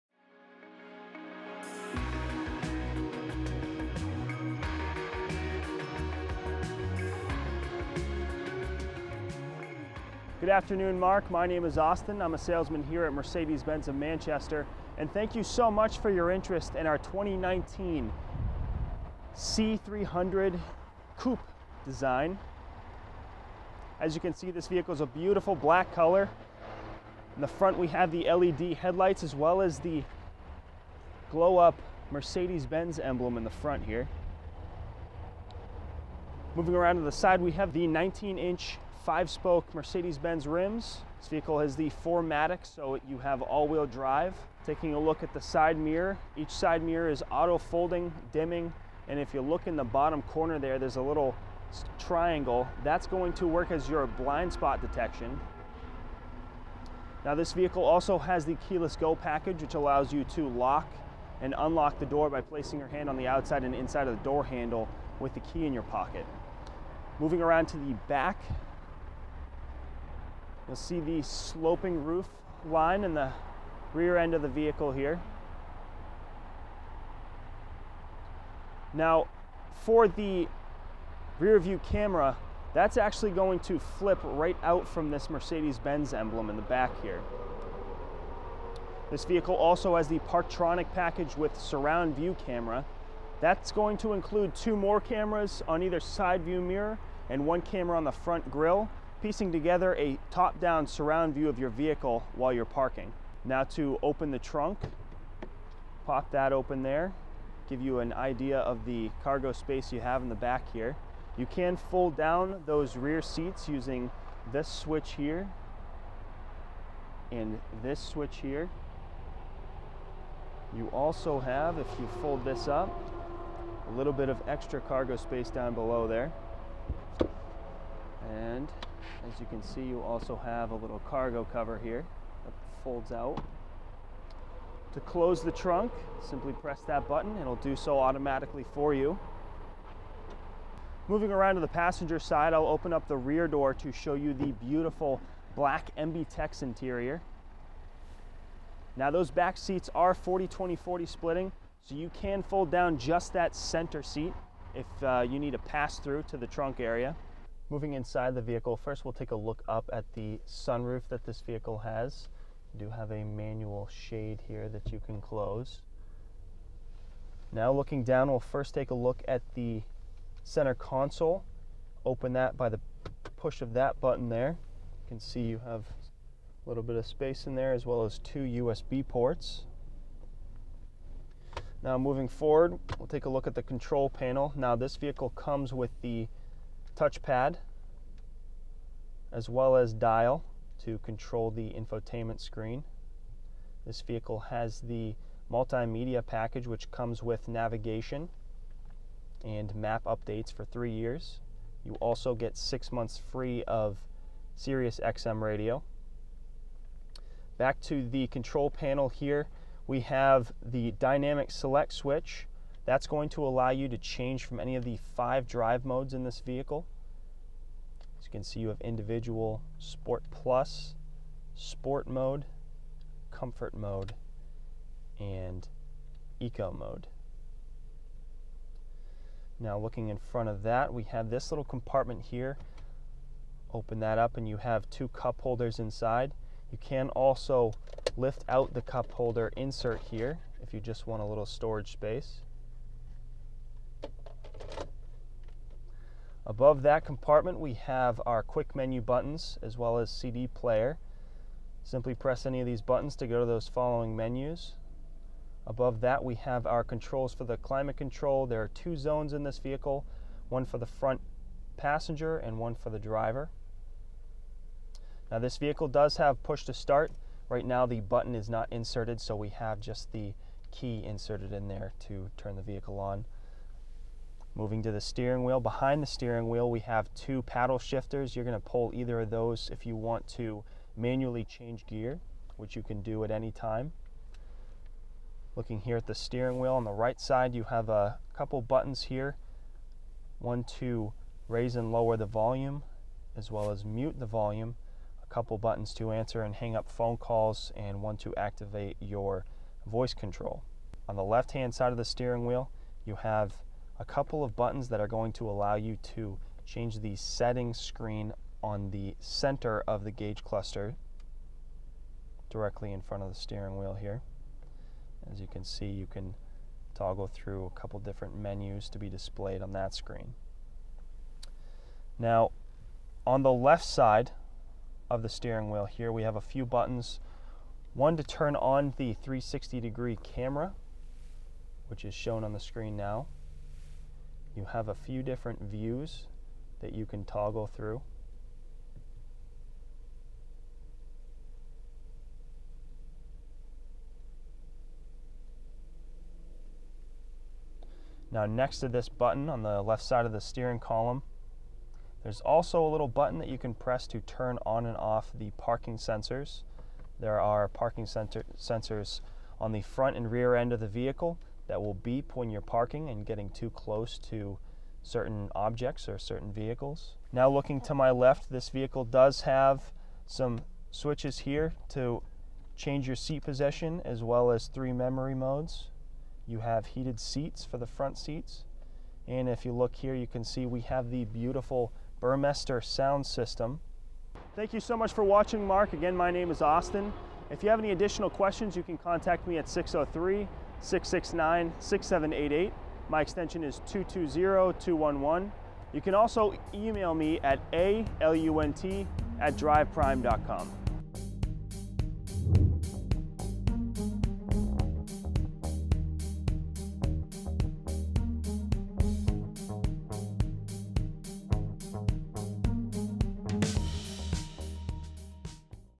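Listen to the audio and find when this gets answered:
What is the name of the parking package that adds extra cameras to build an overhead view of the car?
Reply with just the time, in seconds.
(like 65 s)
90 s.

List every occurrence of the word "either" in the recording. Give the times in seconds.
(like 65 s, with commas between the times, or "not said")
95 s, 278 s.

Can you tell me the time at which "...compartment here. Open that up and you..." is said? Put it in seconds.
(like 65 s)
231 s.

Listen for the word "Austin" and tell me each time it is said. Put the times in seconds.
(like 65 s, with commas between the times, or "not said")
11 s, 386 s.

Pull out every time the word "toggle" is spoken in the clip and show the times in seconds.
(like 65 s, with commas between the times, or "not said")
316 s, 337 s.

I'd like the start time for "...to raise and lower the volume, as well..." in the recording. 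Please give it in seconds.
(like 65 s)
290 s.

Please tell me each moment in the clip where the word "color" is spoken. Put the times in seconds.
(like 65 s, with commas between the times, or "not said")
25 s.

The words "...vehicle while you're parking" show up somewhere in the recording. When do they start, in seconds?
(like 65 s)
101 s.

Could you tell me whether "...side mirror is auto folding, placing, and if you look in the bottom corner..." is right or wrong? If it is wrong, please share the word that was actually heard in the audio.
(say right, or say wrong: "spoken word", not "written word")
wrong: "dimming", not "placing".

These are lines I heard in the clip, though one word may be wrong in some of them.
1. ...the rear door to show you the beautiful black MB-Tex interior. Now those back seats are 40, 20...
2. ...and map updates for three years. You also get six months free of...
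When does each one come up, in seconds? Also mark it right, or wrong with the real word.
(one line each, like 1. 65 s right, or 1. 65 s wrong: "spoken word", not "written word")
1. 143 s right
2. 199 s right.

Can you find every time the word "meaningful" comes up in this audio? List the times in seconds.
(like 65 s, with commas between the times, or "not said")
not said.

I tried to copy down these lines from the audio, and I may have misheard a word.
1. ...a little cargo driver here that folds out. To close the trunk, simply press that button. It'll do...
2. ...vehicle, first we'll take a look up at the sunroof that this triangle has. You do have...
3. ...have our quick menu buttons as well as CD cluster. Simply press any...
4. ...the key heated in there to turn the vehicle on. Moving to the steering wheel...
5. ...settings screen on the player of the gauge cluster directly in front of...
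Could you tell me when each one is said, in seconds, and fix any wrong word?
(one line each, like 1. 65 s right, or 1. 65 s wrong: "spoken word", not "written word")
1. 130 s wrong: "cover", not "driver"
2. 158 s wrong: "vehicle", not "triangle"
3. 247 s wrong: "player", not "cluster"
4. 270 s wrong: "inserted", not "heated"
5. 307 s wrong: "center", not "player".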